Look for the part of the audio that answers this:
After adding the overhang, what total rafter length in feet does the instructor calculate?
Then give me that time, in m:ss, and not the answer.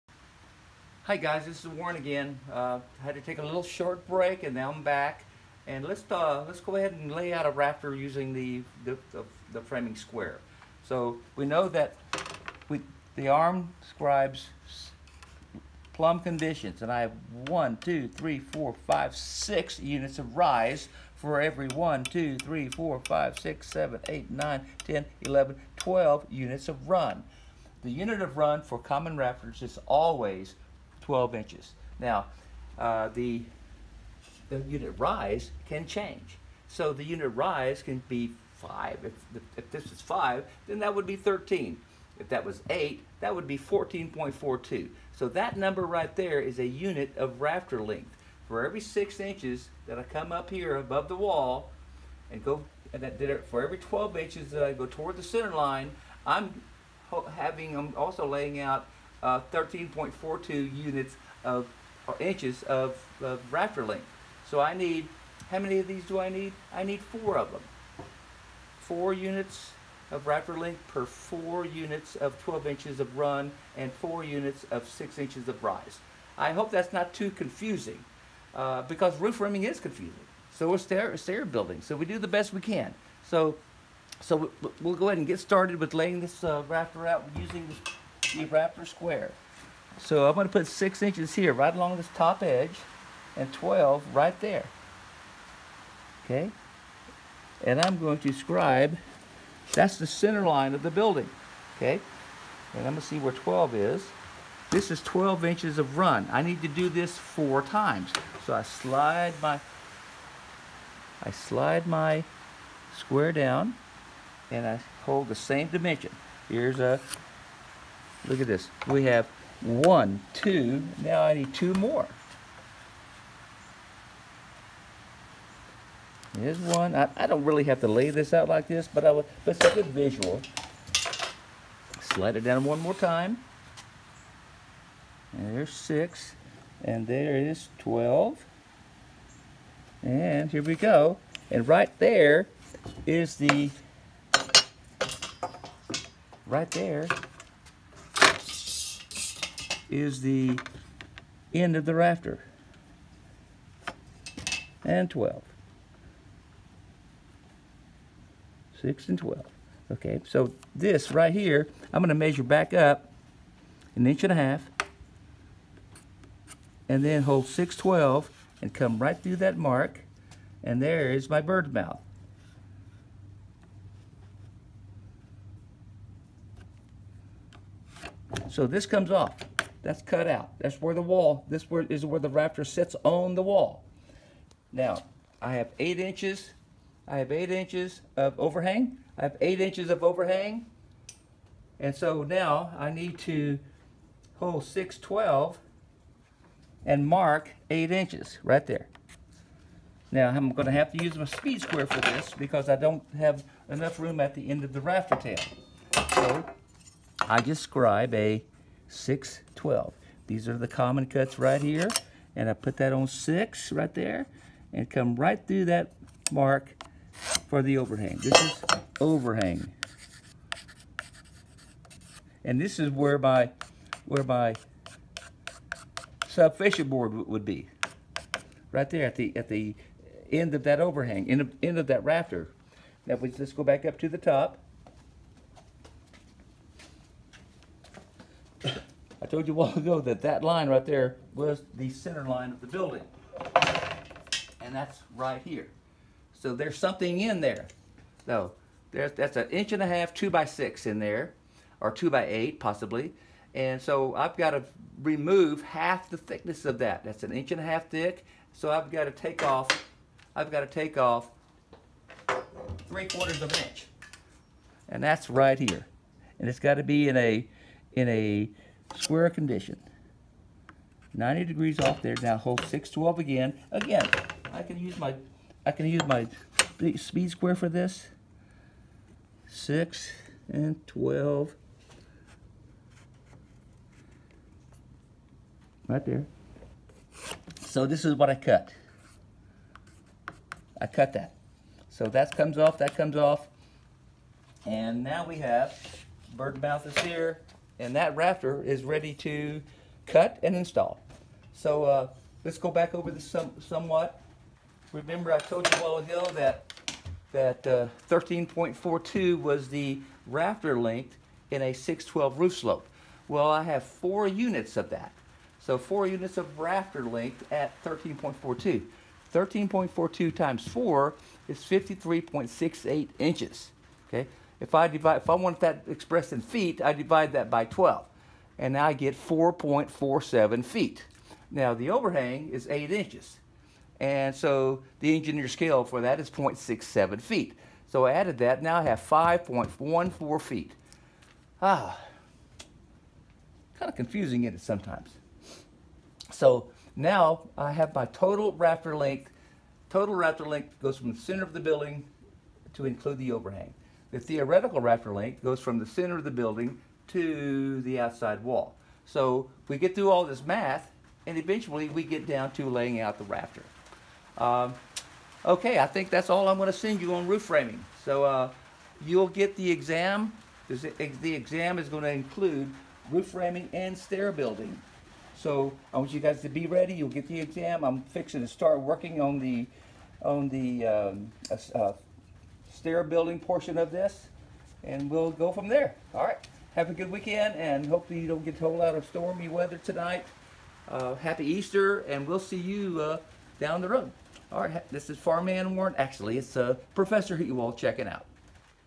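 5:39.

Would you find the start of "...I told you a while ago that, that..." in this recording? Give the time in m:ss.
5:05.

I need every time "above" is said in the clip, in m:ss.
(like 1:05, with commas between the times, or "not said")
0:50.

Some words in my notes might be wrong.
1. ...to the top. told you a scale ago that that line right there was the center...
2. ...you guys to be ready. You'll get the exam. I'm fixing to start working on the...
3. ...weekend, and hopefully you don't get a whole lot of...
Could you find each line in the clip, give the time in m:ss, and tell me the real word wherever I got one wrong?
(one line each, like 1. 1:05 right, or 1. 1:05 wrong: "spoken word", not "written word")
1. 3:53 wrong: "while", not "scale"
2. 6:16 right
3. 6:27 right.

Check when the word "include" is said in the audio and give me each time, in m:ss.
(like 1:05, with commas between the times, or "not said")
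5:52, 6:12.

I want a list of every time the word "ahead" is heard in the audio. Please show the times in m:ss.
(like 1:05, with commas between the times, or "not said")
0:06, 1:25.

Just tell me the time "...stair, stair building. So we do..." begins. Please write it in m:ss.
1:20.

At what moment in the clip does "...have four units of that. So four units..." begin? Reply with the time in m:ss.
5:13.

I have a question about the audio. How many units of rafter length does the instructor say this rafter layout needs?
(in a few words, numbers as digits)
4.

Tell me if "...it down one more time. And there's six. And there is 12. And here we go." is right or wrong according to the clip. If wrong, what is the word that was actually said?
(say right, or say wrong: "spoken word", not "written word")
right.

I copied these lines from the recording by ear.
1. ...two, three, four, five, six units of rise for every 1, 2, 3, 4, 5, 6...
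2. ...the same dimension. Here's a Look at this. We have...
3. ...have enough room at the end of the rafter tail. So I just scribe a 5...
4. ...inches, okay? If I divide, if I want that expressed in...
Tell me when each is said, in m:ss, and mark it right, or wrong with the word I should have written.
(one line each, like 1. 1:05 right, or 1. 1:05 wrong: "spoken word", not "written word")
1. 0:17 right
2. 1:55 right
3. 3:23 wrong: "6", not "5"
4. 5:23 right.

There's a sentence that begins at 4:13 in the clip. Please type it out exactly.
And so I've got to remove half the thickness of that.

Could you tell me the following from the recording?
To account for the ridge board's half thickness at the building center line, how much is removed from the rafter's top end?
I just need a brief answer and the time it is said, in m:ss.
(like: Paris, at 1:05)
Three quarters of an inch, at 4:22.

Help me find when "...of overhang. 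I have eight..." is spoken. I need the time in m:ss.
3:08.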